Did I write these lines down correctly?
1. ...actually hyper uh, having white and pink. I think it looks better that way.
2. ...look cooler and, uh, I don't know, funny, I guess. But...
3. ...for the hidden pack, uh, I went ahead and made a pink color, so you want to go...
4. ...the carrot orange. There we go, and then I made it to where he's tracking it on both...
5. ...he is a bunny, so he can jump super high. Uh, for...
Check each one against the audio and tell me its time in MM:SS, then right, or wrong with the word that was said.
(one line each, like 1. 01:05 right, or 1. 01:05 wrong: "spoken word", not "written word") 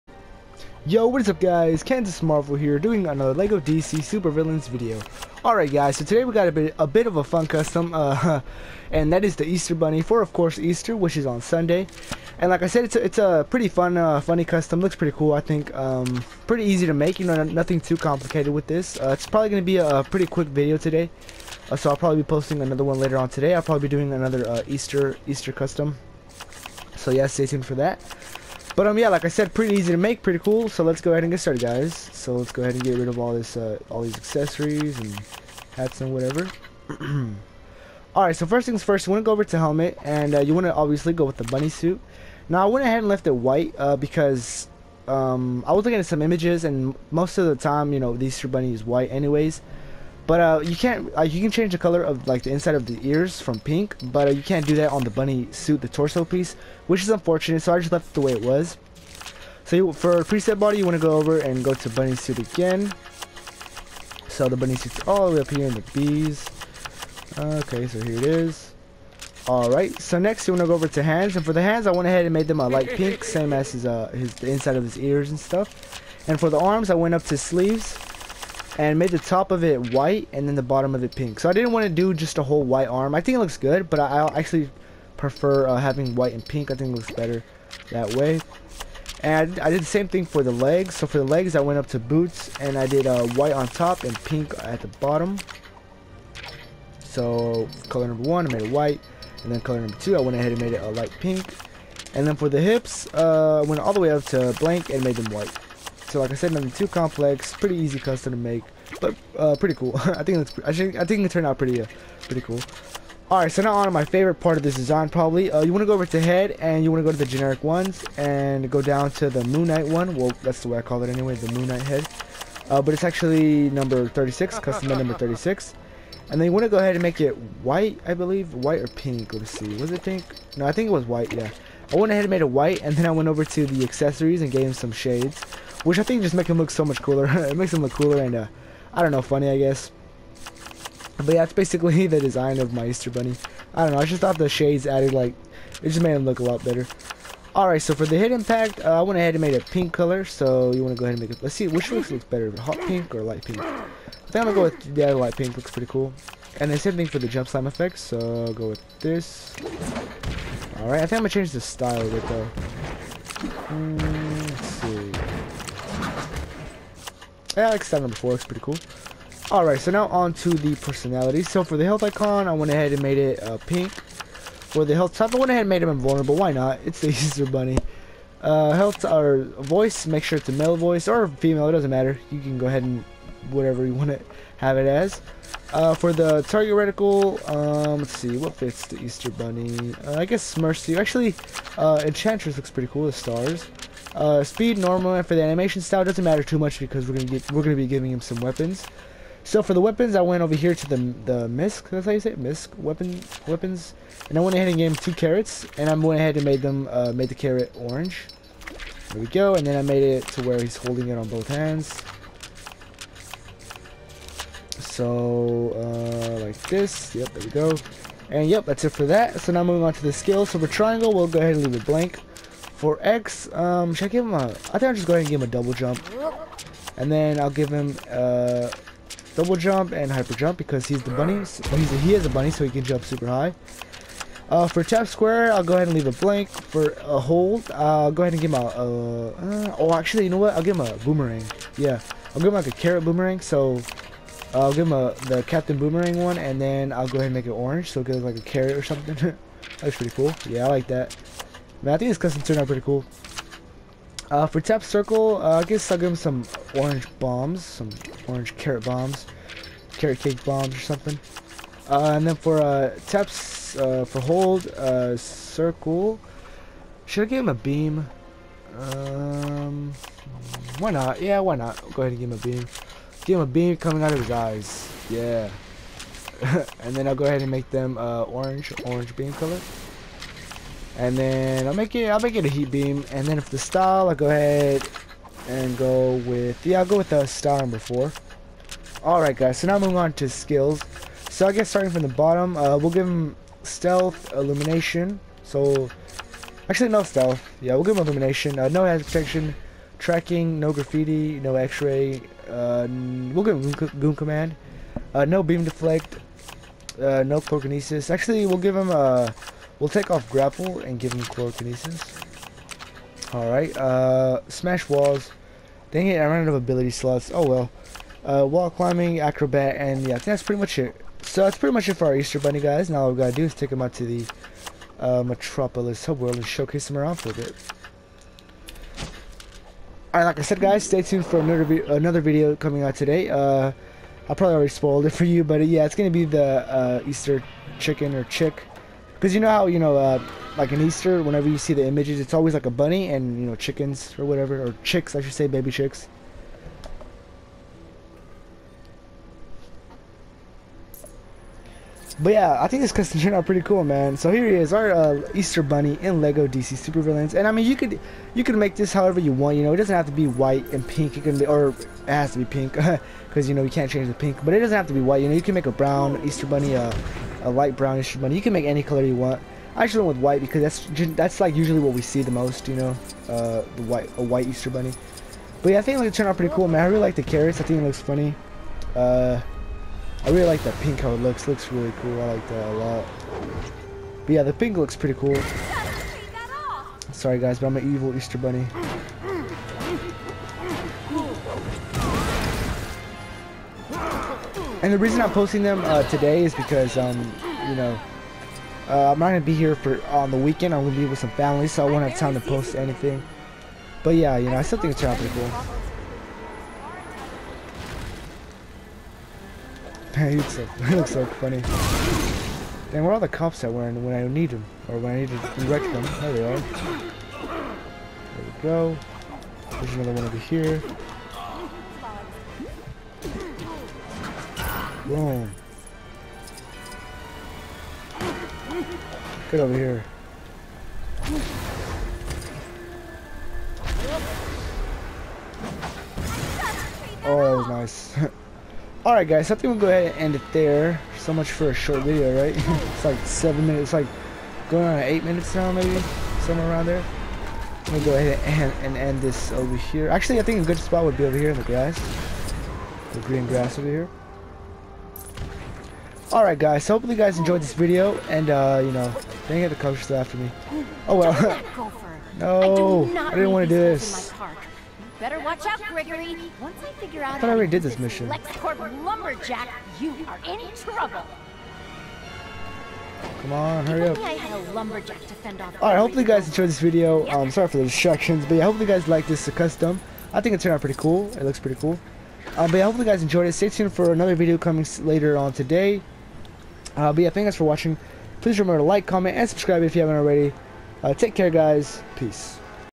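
1. 01:24 wrong: "prefer", not "hyper"
2. 02:17 right
3. 02:27 right
4. 03:27 wrong: "holding", not "tracking"
5. 03:51 right.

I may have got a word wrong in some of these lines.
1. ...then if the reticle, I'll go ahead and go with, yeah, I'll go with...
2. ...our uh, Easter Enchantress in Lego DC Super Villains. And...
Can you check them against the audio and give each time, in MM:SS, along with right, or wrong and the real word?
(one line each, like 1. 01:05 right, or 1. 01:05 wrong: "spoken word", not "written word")
1. 04:43 wrong: "style", not "reticle"
2. 05:54 wrong: "Bunny", not "Enchantress".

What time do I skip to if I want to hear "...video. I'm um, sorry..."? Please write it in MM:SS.
07:56.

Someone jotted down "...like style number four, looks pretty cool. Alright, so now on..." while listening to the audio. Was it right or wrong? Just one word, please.
right.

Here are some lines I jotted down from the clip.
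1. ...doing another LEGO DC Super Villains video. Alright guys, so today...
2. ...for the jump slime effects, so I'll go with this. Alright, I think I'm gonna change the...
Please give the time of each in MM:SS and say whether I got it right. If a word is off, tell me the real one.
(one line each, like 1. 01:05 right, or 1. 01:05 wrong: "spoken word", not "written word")
1. 00:02 right
2. 02:37 right.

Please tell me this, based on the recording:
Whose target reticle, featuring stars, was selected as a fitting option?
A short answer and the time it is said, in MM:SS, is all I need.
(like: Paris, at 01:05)
Enchantress, at 03:12.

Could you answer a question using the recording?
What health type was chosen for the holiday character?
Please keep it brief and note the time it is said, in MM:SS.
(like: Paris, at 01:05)
invulnerable, at 02:55.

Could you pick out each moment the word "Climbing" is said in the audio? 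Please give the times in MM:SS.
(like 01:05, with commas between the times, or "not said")
05:18.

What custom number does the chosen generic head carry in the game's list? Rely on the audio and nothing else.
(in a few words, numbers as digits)
36.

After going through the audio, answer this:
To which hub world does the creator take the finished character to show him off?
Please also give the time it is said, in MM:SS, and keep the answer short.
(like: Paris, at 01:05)
Metropolis, at 05:25.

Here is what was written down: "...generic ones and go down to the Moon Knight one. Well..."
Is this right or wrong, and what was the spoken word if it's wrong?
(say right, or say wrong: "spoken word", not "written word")
right.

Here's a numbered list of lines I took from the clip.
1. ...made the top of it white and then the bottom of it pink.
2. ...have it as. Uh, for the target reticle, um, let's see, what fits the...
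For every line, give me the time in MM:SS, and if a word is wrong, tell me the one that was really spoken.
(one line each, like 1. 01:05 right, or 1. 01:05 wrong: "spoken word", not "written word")
1. 01:18 right
2. 03:04 right.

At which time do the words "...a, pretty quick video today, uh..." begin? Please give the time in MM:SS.
00:19.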